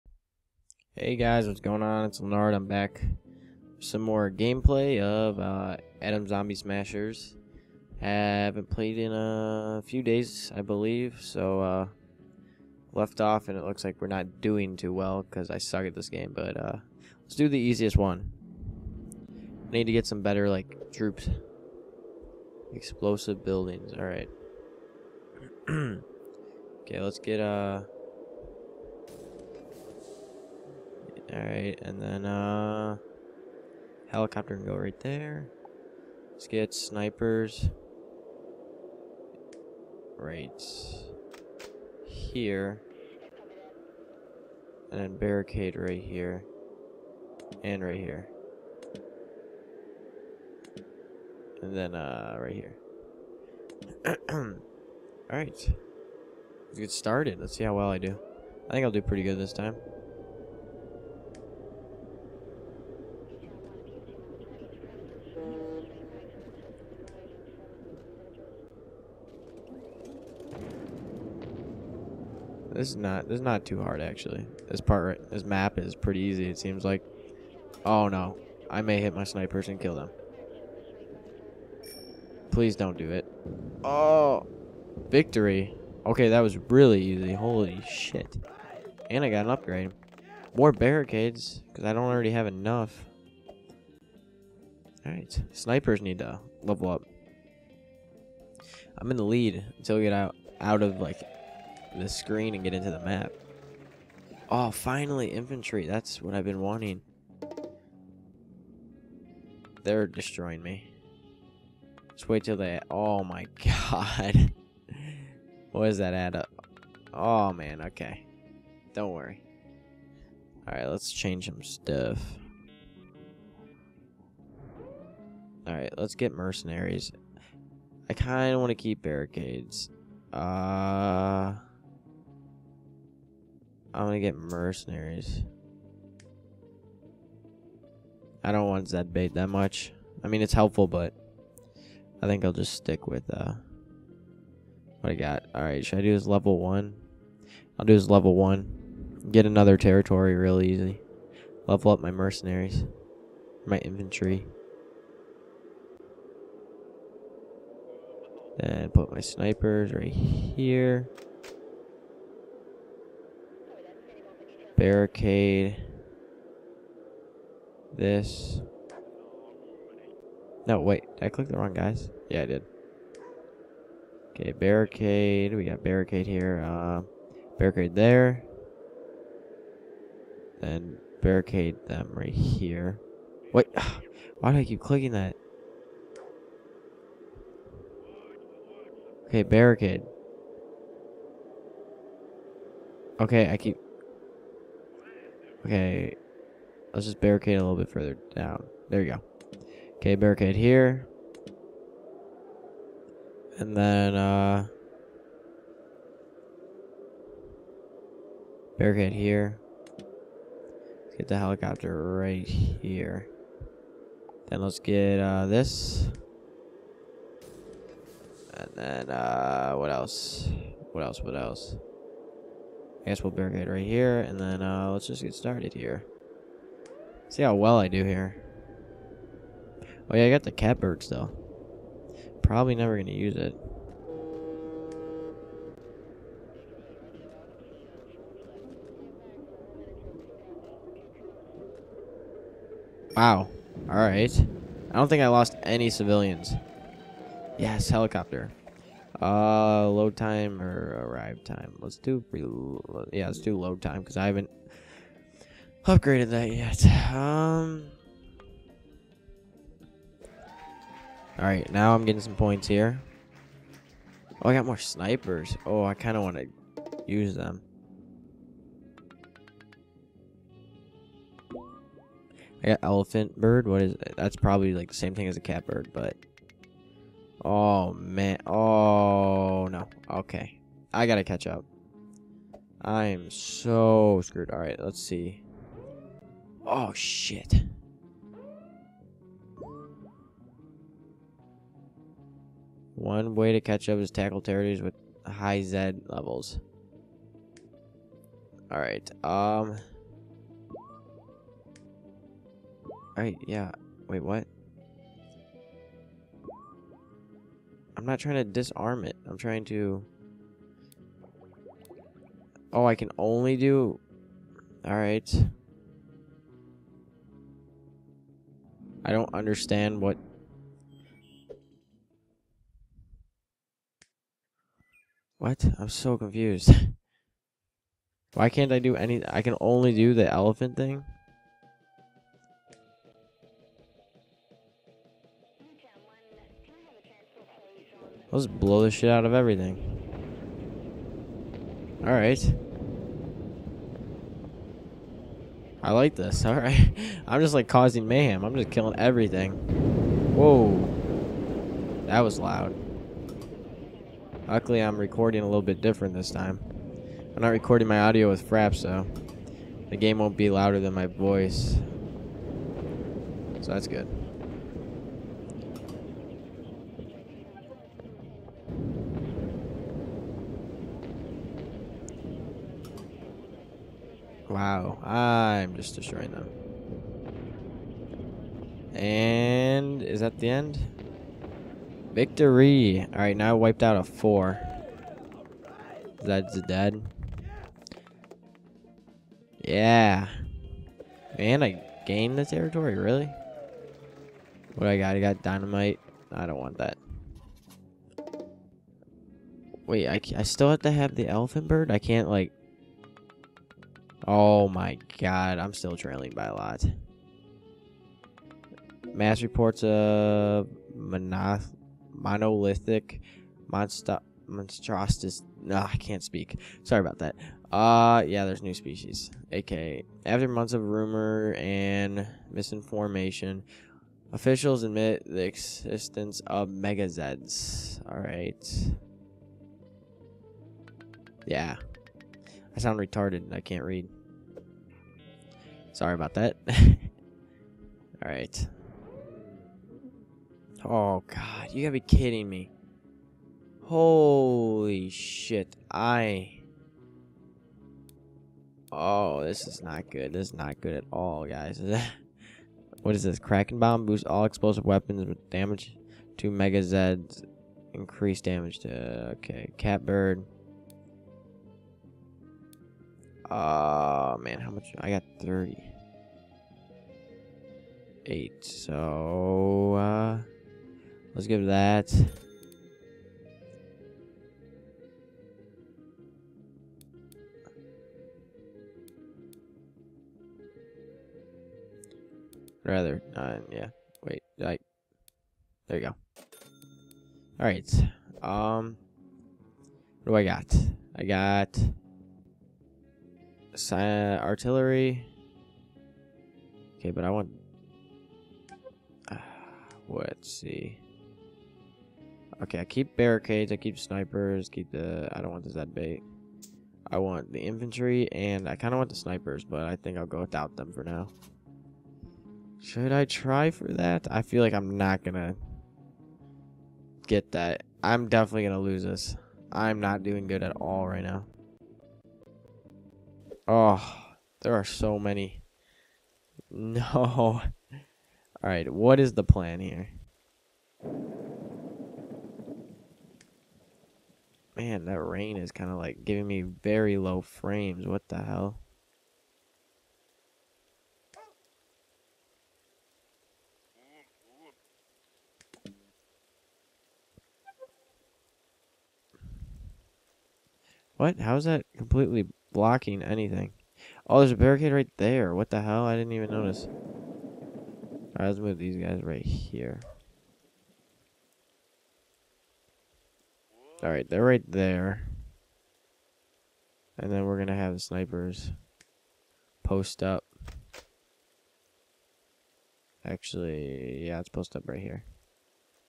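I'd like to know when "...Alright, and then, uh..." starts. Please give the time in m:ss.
0:31.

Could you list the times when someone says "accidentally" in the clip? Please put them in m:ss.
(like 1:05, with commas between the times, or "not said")
not said.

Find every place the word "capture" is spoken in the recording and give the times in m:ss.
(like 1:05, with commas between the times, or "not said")
not said.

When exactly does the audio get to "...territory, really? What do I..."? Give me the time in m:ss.
6:32.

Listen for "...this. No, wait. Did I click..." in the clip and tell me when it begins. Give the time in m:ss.
2:47.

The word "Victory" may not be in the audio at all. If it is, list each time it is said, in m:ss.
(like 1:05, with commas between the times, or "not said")
1:25, 6:22.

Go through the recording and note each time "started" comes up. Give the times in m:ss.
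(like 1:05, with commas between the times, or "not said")
0:56, 3:45.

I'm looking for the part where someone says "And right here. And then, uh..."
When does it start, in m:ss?
0:47.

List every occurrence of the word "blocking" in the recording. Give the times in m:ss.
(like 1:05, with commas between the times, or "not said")
9:12.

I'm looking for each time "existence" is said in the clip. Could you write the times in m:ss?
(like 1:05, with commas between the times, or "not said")
7:05.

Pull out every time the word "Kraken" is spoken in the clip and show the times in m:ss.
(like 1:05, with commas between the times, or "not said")
7:33.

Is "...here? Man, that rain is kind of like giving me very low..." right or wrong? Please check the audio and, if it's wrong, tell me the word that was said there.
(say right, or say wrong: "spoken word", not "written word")
right.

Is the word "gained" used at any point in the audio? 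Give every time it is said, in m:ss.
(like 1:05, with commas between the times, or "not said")
6:32.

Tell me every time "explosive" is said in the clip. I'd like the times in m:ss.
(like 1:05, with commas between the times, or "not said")
0:22, 7:34.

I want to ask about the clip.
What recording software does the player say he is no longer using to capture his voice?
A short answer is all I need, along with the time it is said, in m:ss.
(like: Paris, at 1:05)
Fraps, at 5:58.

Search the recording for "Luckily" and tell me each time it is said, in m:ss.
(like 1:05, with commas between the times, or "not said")
5:54.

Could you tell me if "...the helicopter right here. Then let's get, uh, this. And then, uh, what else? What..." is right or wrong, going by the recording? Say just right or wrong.
right.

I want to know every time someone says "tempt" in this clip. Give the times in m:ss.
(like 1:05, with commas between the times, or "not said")
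not said.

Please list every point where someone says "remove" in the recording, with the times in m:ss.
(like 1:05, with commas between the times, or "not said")
not said.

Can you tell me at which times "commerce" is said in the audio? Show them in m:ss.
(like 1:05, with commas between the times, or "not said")
not said.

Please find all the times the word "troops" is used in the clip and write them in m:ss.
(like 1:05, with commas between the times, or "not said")
0:20.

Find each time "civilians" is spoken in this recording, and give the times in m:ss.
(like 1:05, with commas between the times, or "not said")
4:05.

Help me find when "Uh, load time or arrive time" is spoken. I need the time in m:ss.
4:09.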